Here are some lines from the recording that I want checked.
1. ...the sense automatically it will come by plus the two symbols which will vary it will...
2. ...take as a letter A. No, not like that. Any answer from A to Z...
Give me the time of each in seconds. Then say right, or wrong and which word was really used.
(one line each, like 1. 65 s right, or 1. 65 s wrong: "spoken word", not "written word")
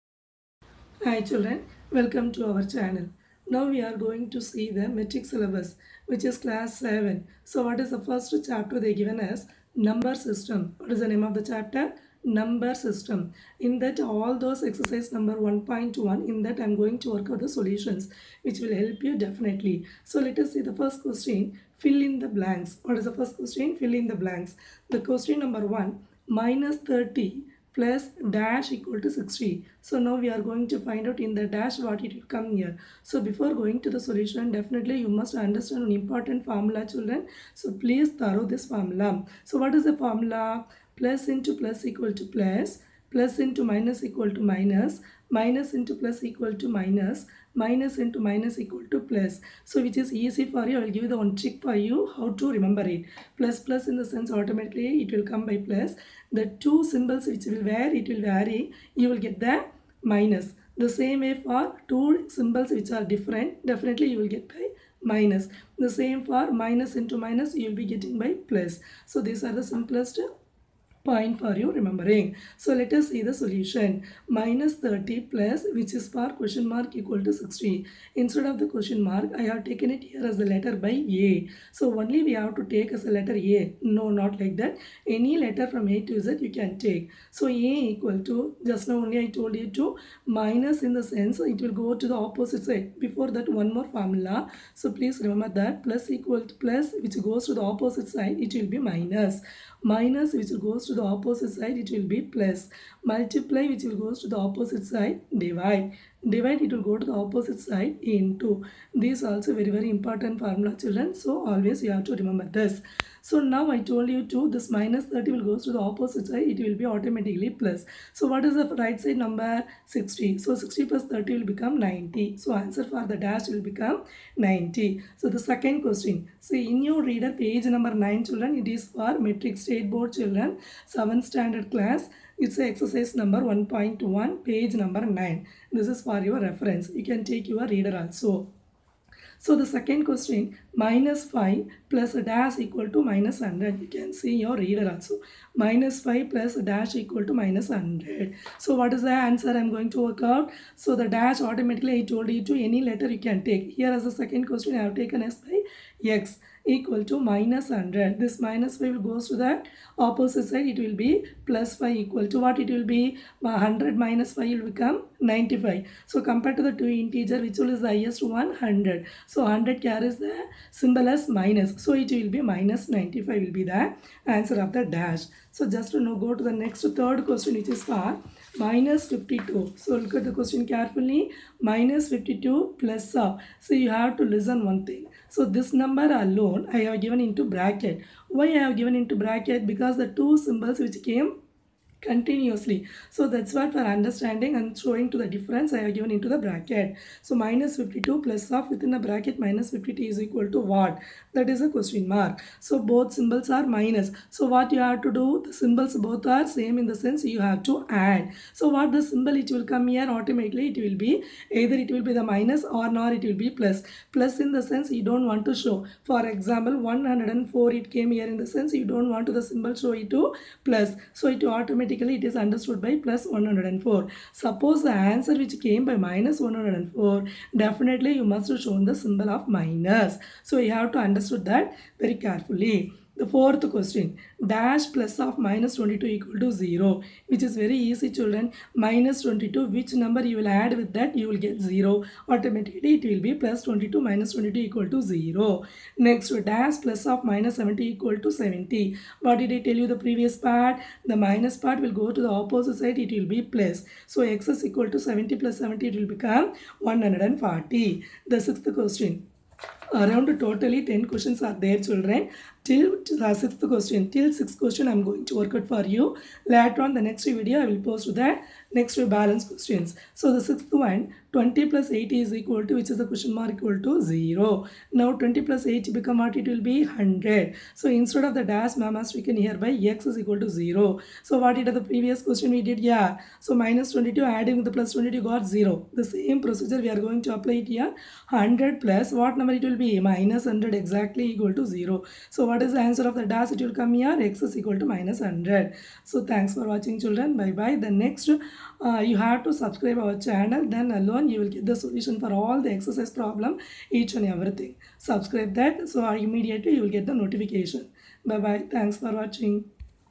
1. 53 s right
2. 82 s wrong: "letter", not "answer".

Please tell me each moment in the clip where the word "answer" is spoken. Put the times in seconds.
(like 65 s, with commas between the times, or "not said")
122 s, 149 s, 174 s, 224 s, 292 s.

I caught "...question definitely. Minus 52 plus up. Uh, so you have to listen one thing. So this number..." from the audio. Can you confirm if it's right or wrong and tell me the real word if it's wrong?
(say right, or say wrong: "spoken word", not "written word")
wrong: "carefully", not "definitely".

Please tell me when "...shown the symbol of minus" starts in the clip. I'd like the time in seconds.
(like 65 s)
228 s.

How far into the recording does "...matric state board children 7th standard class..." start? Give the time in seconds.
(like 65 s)
129 s.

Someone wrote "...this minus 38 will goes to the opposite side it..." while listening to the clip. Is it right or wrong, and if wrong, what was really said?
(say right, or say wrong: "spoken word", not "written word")
wrong: "30", not "38".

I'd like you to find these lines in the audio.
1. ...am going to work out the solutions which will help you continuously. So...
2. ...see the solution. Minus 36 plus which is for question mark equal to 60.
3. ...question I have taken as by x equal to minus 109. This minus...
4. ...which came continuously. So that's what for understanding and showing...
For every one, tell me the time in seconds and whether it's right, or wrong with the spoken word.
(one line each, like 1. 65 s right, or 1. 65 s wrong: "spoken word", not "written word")
1. 16 s wrong: "definitely", not "continuously"
2. 73 s wrong: "30", not "36"
3. 154 s wrong: "100", not "109"
4. 190 s right.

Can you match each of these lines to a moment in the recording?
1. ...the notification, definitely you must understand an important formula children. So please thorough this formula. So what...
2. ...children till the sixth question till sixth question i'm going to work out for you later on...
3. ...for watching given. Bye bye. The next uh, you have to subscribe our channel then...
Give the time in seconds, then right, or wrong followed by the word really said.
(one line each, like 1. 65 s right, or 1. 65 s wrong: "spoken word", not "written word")
1. 33 s wrong: "solution", not "notification"
2. 261 s right
3. 296 s wrong: "children", not "given".